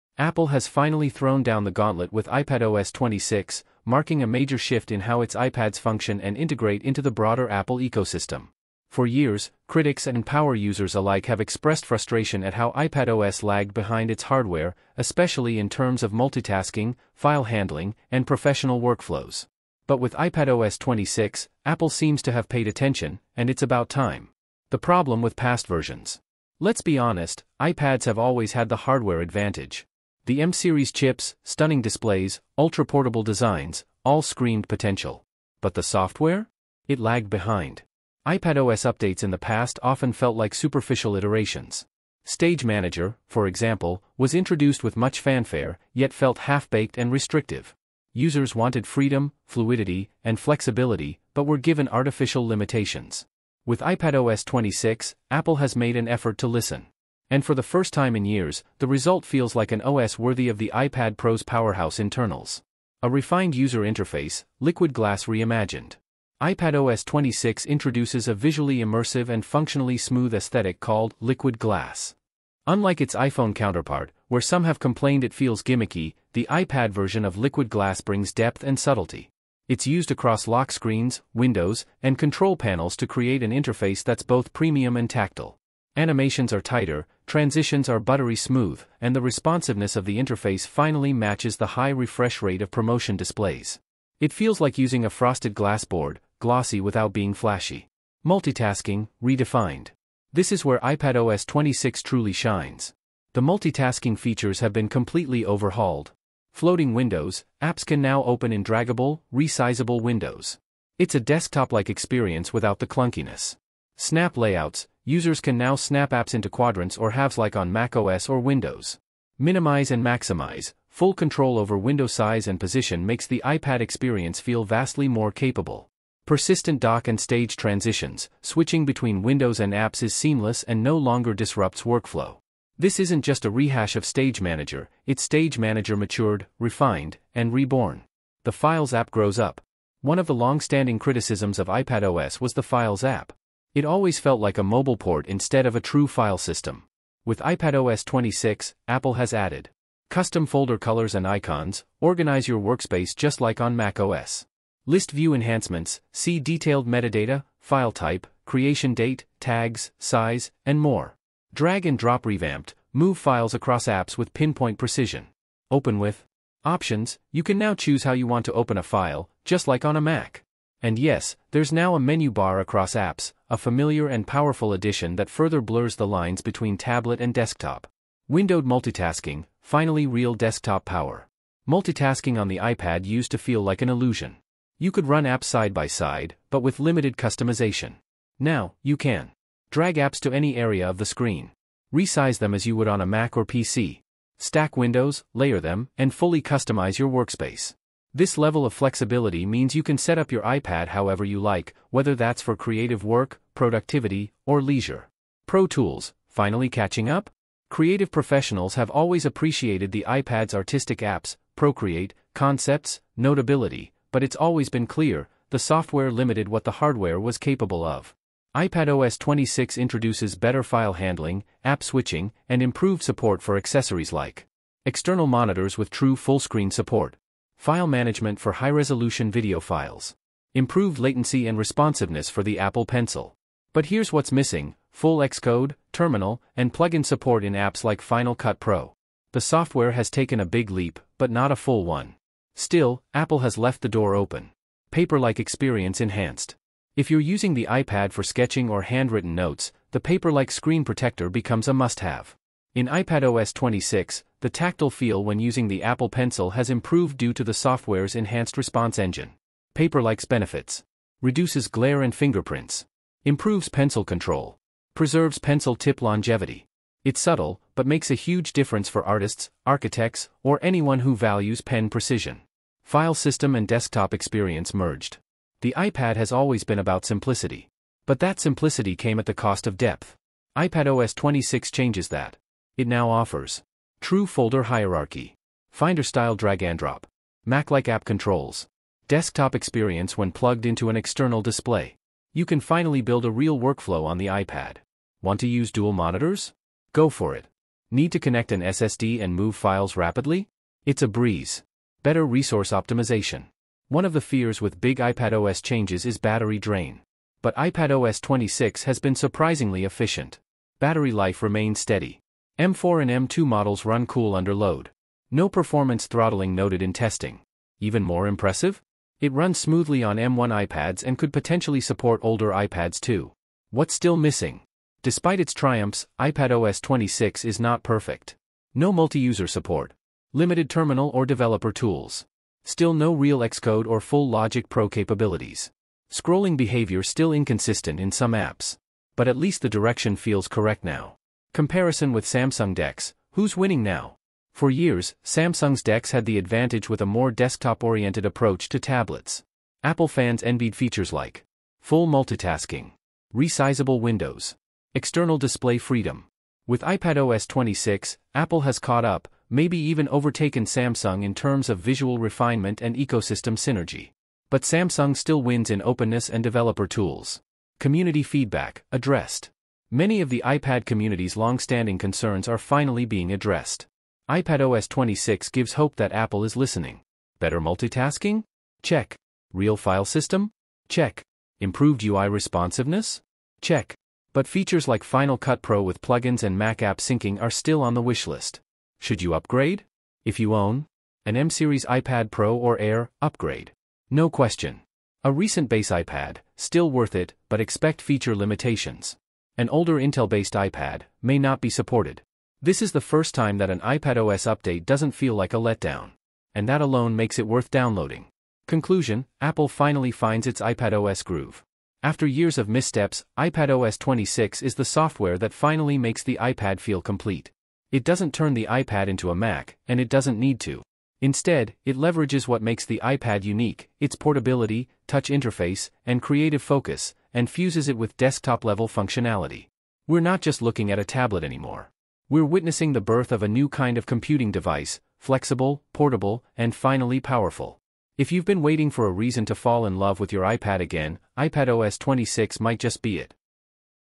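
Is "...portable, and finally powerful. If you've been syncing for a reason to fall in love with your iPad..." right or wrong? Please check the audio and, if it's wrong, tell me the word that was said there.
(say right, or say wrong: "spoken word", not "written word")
wrong: "waiting", not "syncing".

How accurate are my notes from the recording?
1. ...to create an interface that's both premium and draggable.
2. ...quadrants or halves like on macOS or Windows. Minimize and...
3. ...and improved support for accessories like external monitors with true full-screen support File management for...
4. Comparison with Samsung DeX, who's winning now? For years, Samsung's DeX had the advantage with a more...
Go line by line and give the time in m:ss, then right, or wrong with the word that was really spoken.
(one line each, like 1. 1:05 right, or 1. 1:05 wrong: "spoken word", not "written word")
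1. 1:22 wrong: "tactile", not "draggable"
2. 1:56 right
3. 3:42 right
4. 5:41 right.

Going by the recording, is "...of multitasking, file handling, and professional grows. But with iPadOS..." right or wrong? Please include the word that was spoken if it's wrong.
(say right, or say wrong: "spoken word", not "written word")
wrong: "workflows", not "grows".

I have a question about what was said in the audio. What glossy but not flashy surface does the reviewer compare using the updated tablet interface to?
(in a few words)
Frosted glass board.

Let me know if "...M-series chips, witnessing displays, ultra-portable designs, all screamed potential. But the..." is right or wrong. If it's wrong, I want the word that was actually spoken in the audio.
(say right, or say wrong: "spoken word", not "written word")
wrong: "stunning", not "witnessing".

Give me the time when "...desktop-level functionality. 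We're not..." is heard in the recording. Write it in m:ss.
7:08.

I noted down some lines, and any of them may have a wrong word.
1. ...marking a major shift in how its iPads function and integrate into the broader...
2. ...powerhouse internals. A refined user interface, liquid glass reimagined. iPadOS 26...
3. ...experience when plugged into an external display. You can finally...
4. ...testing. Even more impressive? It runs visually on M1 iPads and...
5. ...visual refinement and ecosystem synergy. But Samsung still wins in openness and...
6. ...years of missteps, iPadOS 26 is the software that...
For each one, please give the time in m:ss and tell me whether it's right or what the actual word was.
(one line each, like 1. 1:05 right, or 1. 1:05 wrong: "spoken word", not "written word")
1. 0:03 right
2. 1:01 right
3. 4:49 right
4. 5:16 wrong: "smoothly", not "visually"
5. 6:01 right
6. 6:52 right.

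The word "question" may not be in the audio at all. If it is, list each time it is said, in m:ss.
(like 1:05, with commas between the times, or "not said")
6:34.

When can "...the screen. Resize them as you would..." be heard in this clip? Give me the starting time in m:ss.
3:10.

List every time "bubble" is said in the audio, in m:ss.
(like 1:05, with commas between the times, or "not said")
not said.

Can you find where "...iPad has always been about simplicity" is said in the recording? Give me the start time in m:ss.
4:35.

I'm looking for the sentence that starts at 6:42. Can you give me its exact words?
This is the first time that an iPadOS update doesn't feel like a letdown.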